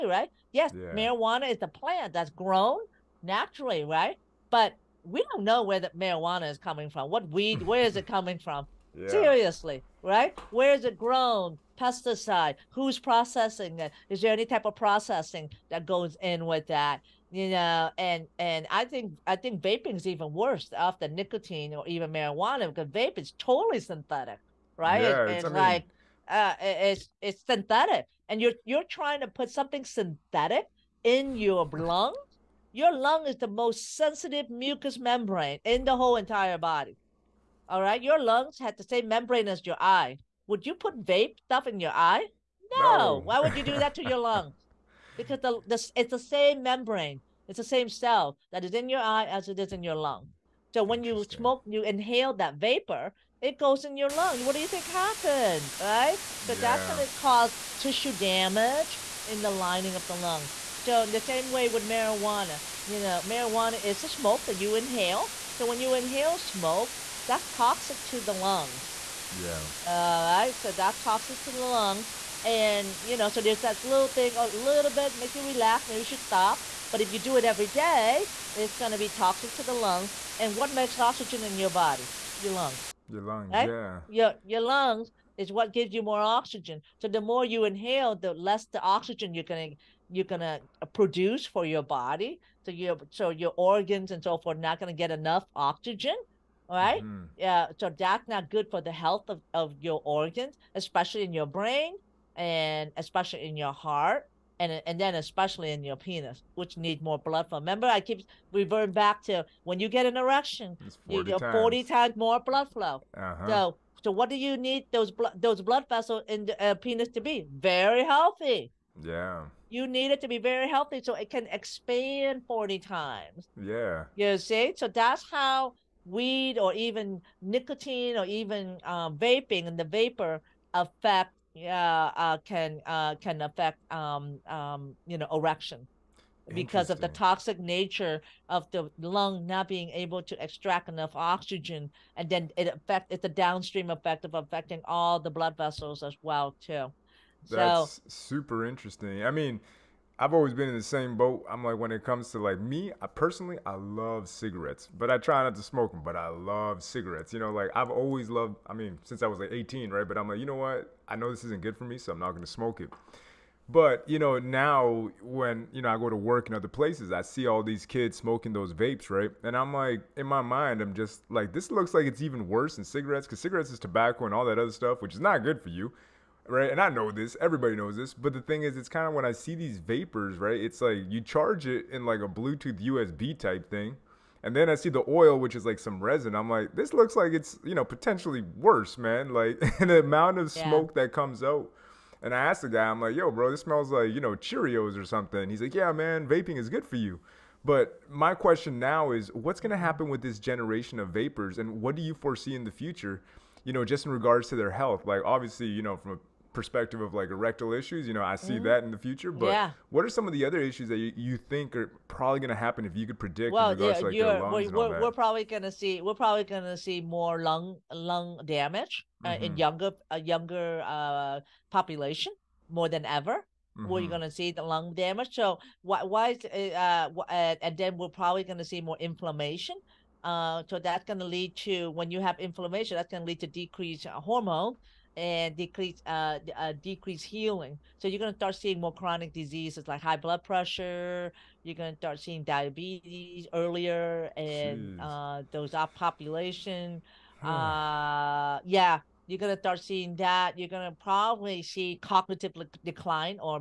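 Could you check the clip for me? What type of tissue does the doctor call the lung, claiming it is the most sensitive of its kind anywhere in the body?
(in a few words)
mucous membrane.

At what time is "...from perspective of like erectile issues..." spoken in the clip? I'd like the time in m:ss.
3:25.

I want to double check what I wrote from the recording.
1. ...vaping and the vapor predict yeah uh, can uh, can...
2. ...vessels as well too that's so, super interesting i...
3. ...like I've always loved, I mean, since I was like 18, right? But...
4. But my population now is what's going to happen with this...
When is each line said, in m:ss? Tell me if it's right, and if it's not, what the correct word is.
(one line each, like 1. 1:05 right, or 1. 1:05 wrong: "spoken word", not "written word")
1. 2:09 wrong: "affect", not "predict"
2. 2:25 right
3. 2:37 right
4. 3:17 wrong: "question", not "population".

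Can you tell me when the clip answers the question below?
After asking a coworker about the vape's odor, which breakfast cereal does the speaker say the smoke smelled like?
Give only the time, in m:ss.
3:14.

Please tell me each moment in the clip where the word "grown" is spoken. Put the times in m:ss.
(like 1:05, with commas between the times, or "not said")
0:02, 0:10.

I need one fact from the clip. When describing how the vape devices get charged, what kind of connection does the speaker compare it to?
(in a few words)
Bluetooth USB.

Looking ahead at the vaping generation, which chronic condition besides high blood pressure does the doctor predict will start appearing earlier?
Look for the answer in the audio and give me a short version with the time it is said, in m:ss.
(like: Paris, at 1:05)
Diabetes, at 4:02.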